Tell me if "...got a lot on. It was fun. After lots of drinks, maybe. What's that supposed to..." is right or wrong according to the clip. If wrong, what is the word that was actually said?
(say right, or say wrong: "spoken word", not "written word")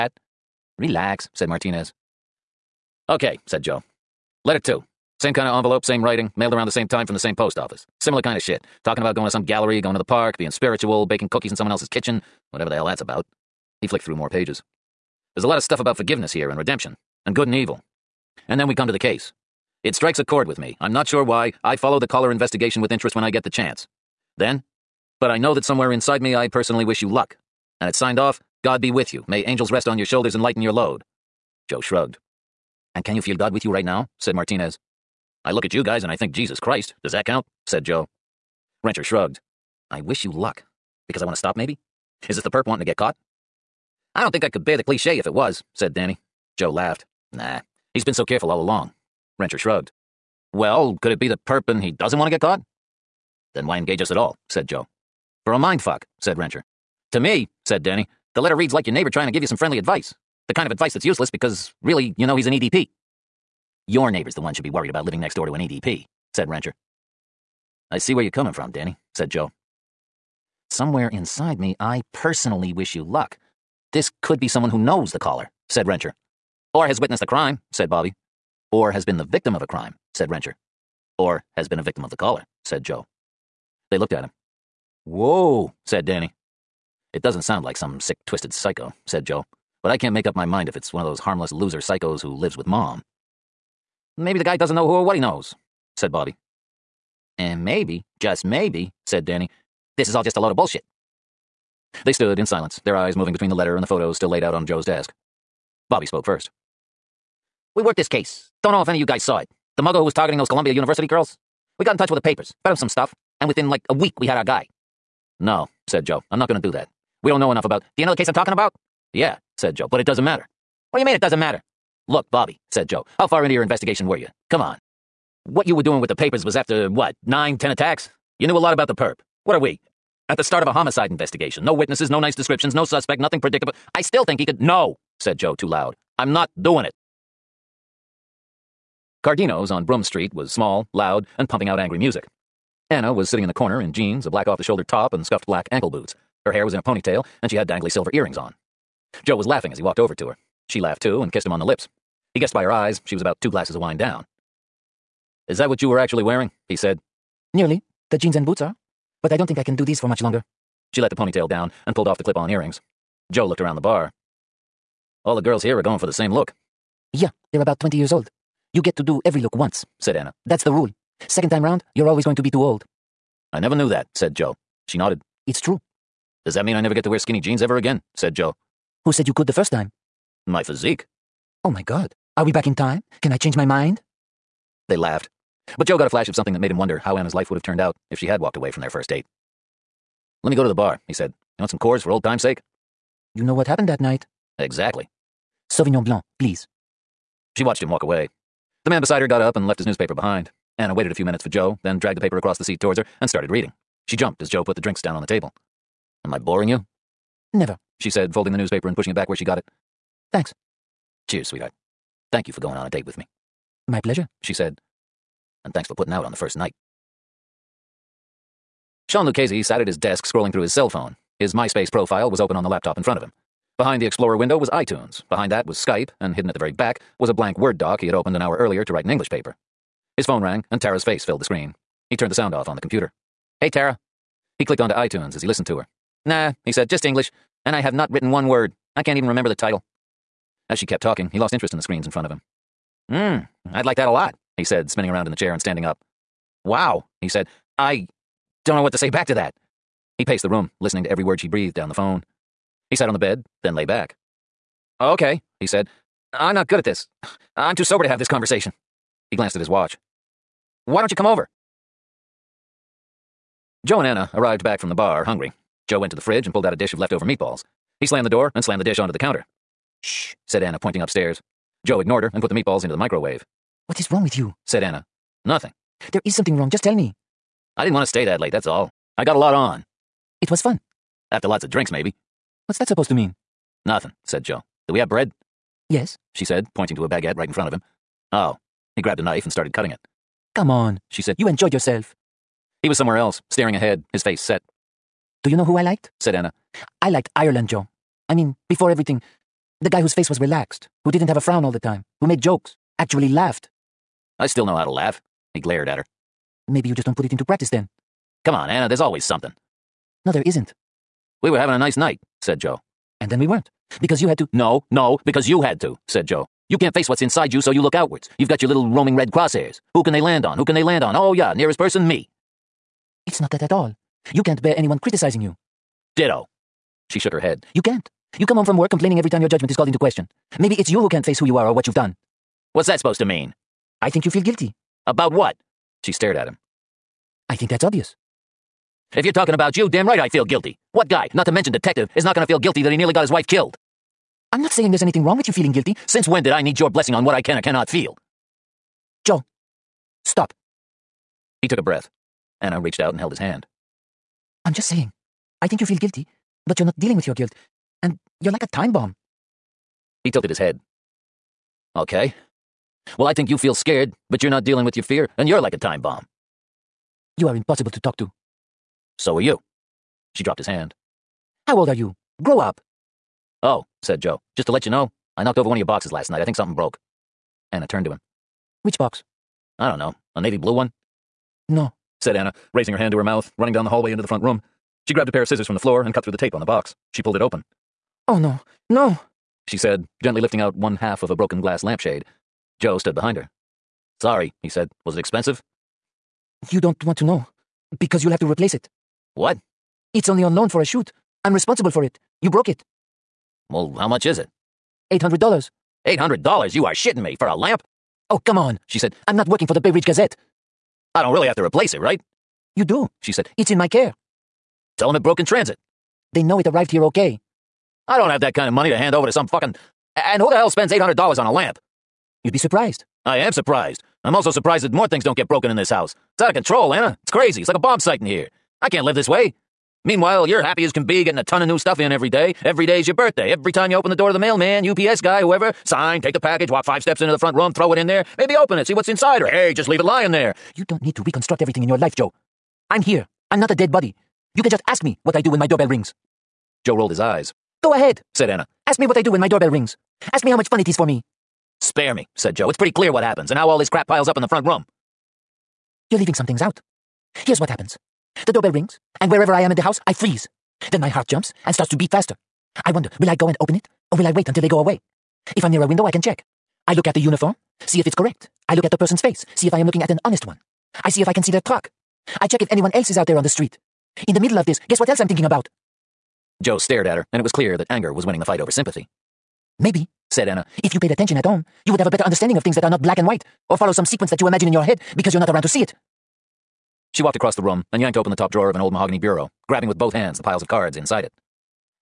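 right.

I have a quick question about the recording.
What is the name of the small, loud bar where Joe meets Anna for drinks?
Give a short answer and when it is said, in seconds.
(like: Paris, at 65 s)
Cardino's, at 139 s.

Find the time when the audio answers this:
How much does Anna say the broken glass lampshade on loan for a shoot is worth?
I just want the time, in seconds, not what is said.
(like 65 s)
405 s.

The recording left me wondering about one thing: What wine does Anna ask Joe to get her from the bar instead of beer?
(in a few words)
Sauvignon Blanc.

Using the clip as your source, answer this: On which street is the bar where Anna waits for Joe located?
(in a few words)
Broome Street.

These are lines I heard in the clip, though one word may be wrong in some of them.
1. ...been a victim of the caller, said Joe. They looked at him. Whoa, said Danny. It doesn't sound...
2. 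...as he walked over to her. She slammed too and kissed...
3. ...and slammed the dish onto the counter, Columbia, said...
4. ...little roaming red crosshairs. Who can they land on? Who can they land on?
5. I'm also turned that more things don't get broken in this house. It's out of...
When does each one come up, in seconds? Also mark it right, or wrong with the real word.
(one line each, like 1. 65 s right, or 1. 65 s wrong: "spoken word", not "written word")
1. 81 s right
2. 149 s wrong: "laughed", not "slammed"
3. 268 s wrong: "Shh", not "Columbia"
4. 318 s right
5. 424 s wrong: "surprised", not "turned".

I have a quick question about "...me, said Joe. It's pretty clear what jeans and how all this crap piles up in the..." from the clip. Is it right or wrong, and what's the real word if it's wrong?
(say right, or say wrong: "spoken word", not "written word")
wrong: "happens", not "jeans".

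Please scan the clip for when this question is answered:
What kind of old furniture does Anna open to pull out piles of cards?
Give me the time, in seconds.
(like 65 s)
488 s.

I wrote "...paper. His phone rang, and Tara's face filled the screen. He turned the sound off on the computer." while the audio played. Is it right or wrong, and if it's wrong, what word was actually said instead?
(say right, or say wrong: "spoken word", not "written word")
right.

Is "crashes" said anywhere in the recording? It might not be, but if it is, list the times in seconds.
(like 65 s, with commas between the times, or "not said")
not said.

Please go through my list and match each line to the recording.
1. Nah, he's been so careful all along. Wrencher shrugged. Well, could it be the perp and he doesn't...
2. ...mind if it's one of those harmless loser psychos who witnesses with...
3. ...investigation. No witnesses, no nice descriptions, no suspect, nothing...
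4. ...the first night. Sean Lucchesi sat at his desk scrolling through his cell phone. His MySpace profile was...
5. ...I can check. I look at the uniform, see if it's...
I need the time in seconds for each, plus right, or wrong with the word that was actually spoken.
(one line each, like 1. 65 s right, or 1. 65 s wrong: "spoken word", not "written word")
1. 47 s right
2. 90 s wrong: "lives", not "witnesses"
3. 131 s right
4. 216 s right
5. 466 s right.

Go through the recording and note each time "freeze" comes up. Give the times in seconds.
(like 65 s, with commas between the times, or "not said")
460 s.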